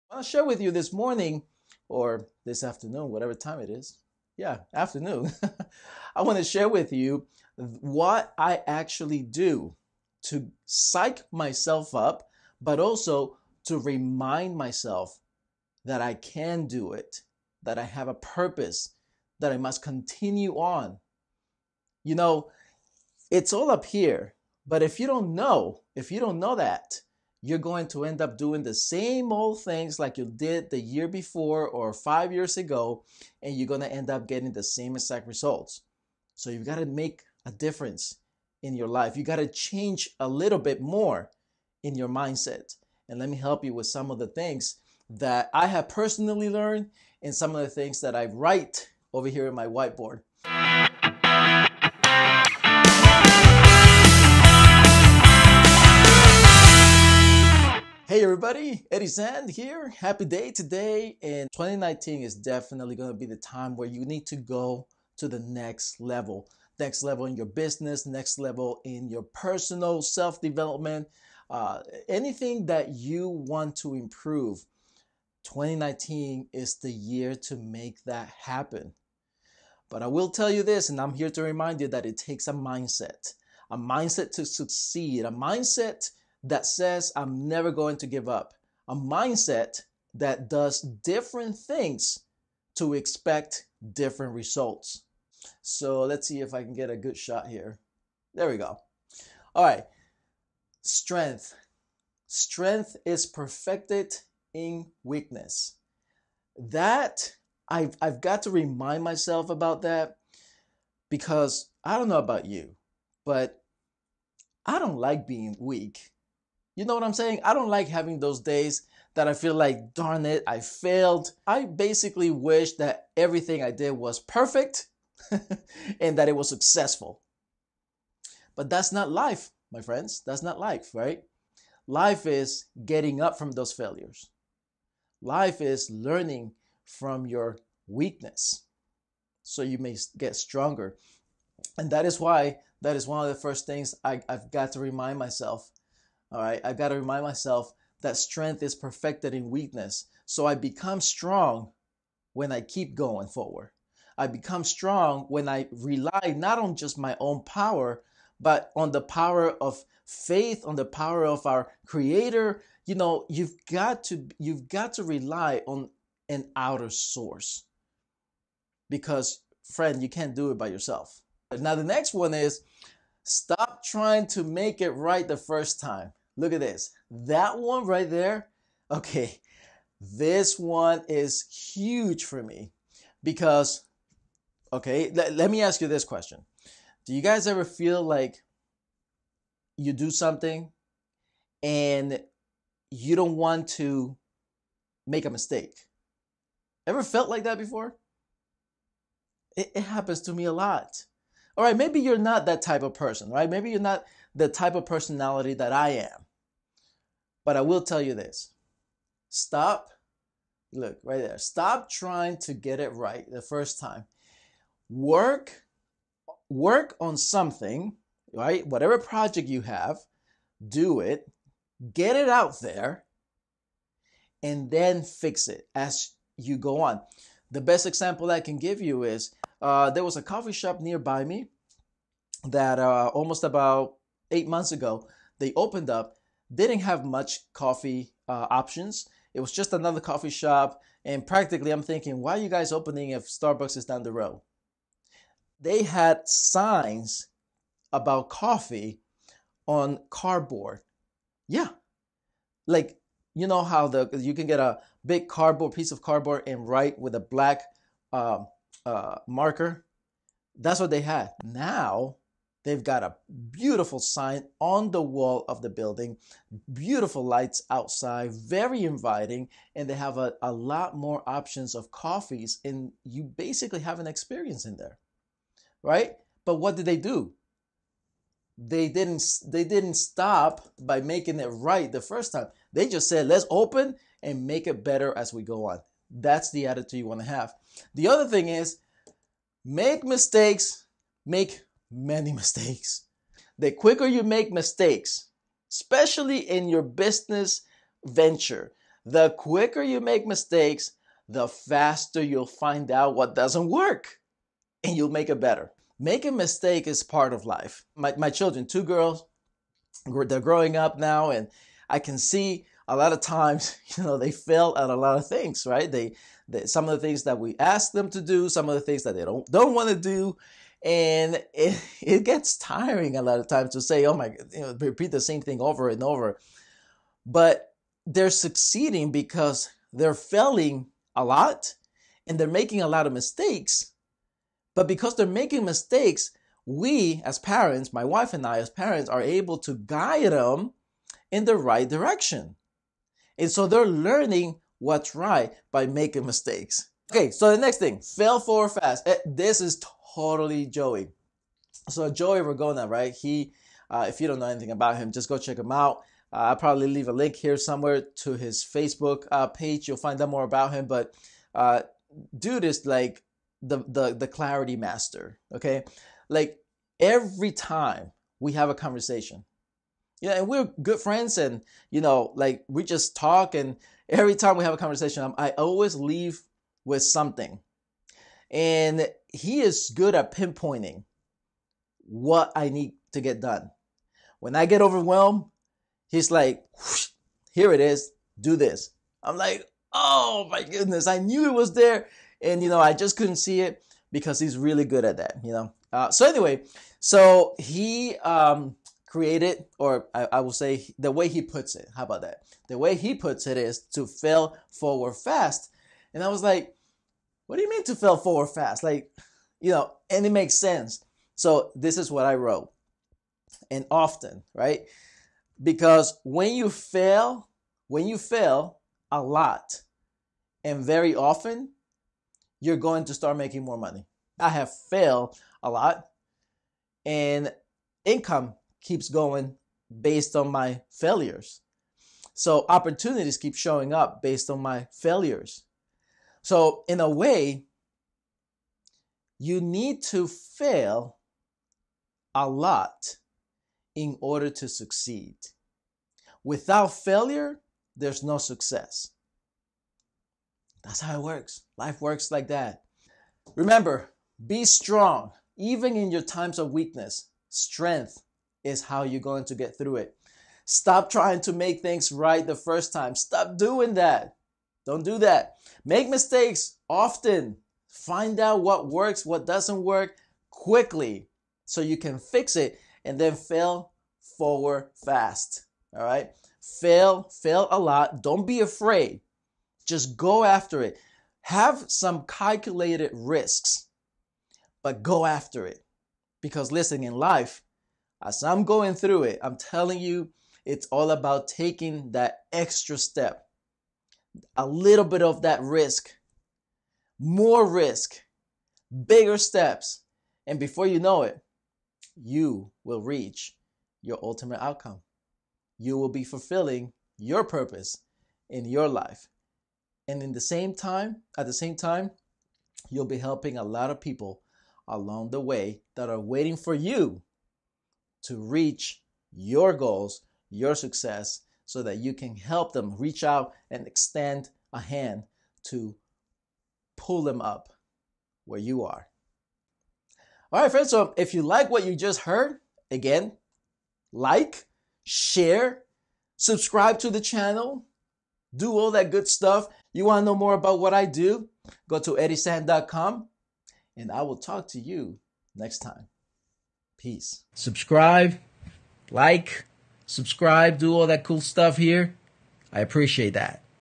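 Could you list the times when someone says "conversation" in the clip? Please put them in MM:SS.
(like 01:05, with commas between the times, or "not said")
06:08, 06:14.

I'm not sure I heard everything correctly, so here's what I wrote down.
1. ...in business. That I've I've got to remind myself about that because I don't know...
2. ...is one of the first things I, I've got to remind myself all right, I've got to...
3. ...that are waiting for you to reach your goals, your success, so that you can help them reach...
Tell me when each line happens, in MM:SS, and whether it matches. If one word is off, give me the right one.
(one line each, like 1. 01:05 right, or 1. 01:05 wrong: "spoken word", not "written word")
1. 01:44 wrong: "weakness", not "business"
2. 02:22 right
3. 08:35 right.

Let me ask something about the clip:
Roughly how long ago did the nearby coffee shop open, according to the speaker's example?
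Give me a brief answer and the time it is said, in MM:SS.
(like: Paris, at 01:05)
About 8 months, at 03:53.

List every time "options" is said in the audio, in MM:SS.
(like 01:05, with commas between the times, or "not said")
03:58, 04:31.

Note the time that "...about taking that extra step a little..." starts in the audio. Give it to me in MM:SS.
08:11.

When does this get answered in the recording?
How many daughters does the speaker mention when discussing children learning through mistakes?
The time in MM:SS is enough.
05:08.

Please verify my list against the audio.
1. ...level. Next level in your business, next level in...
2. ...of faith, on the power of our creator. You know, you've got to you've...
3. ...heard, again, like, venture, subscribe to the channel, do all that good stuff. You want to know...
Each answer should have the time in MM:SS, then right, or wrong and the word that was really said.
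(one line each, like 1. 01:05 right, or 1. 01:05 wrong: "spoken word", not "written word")
1. 01:05 right
2. 02:39 right
3. 08:52 wrong: "share", not "venture".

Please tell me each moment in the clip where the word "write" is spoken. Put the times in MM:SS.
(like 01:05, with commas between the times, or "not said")
00:48, 04:16.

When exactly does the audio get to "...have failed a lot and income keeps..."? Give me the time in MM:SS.
07:04.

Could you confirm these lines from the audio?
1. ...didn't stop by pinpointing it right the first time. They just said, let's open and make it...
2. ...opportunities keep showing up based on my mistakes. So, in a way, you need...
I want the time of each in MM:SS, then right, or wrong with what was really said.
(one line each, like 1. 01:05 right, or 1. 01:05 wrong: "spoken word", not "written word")
1. 04:39 wrong: "making", not "pinpointing"
2. 07:12 wrong: "failures", not "mistakes".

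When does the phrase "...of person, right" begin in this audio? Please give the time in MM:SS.
03:22.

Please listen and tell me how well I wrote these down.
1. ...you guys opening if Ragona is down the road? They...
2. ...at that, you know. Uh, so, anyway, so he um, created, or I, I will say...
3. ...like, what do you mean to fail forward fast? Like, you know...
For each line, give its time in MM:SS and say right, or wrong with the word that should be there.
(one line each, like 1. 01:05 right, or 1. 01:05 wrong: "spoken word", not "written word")
1. 04:02 wrong: "Starbucks", not "Ragona"
2. 06:35 right
3. 06:46 right.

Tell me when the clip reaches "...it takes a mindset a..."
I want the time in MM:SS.
01:22.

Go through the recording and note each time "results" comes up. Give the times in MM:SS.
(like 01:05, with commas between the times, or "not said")
00:35, 01:34.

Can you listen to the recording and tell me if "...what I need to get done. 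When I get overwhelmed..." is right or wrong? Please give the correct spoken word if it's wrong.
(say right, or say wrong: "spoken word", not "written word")
right.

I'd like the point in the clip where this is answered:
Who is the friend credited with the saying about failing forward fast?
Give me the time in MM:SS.
05:52.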